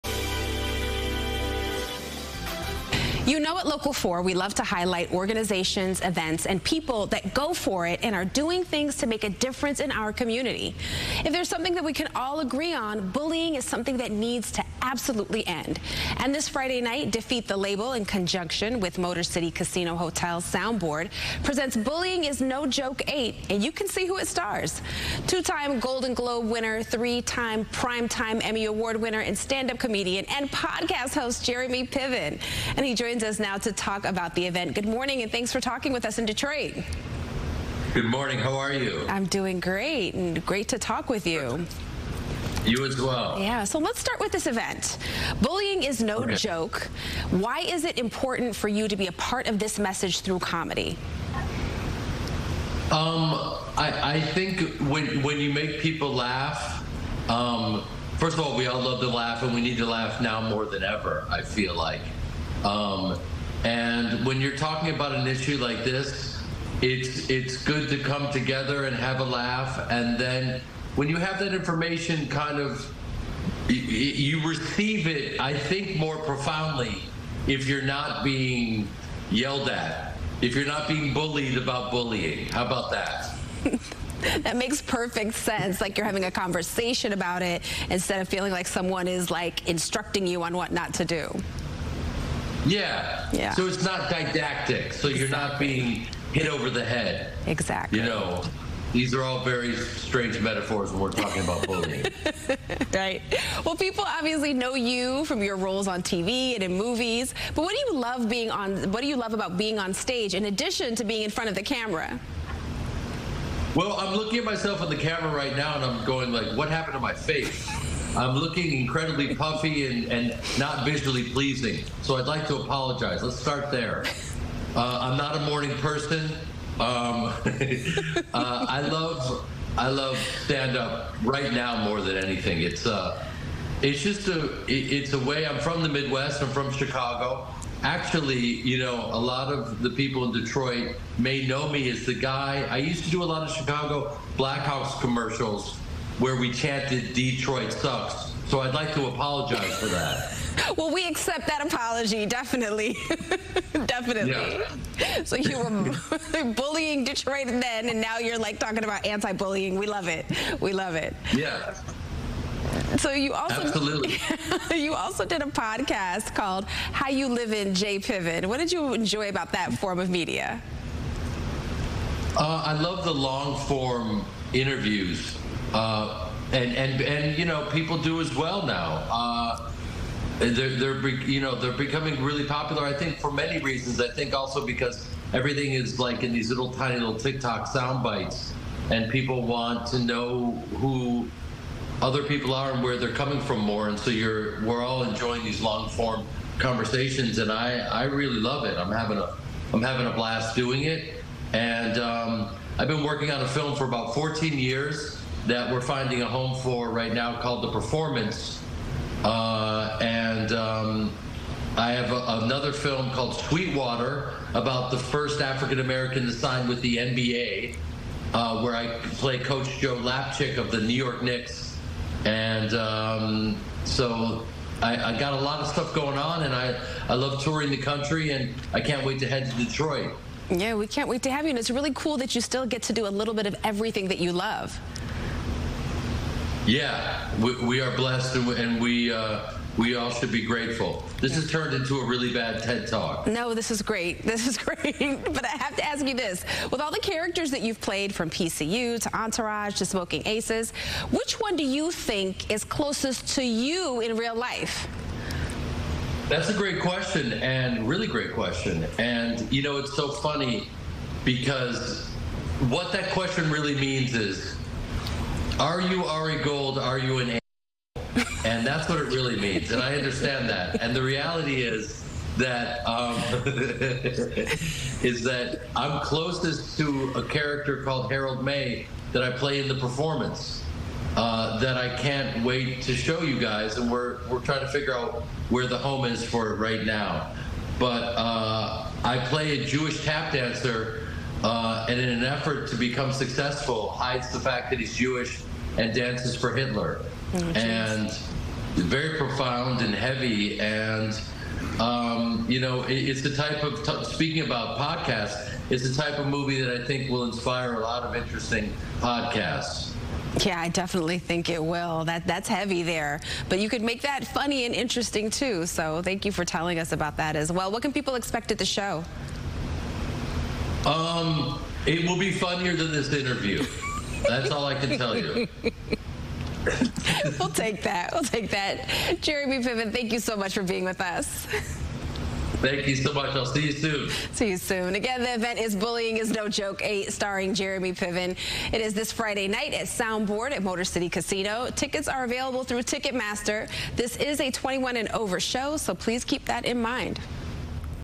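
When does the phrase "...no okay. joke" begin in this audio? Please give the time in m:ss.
0:46.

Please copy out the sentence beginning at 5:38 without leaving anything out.
It is this Friday night at Soundboard at Motor City Casino.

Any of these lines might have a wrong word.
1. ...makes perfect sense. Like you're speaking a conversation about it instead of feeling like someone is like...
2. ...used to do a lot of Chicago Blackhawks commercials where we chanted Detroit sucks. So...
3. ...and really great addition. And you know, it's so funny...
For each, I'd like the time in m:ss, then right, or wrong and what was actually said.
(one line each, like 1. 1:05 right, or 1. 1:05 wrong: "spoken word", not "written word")
1. 1:24 wrong: "having", not "speaking"
2. 2:22 right
3. 4:17 wrong: "question", not "addition".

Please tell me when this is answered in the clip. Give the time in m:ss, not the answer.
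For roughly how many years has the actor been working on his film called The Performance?
3:24.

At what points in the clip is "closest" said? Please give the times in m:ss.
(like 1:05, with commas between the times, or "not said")
4:12, 4:35.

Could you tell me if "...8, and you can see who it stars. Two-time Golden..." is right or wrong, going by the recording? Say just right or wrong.
right.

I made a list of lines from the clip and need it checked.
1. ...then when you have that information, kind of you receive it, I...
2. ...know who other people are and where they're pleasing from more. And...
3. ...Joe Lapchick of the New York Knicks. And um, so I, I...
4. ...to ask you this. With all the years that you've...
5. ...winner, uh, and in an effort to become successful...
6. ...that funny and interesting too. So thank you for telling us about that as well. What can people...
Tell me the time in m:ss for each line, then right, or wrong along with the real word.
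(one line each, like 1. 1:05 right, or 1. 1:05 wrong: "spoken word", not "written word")
1. 1:10 right
2. 3:09 wrong: "coming", not "pleasing"
3. 3:39 right
4. 4:05 wrong: "characters", not "years"
5. 4:50 wrong: "dancer", not "winner"
6. 5:14 right.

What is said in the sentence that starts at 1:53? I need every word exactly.
Well, I'm looking at myself on the camera right now and I'm going like, what happened to my face?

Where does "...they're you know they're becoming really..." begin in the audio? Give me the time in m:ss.
3:00.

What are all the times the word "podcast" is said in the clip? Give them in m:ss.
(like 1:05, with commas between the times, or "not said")
0:30, 2:45, 5:04, 5:08.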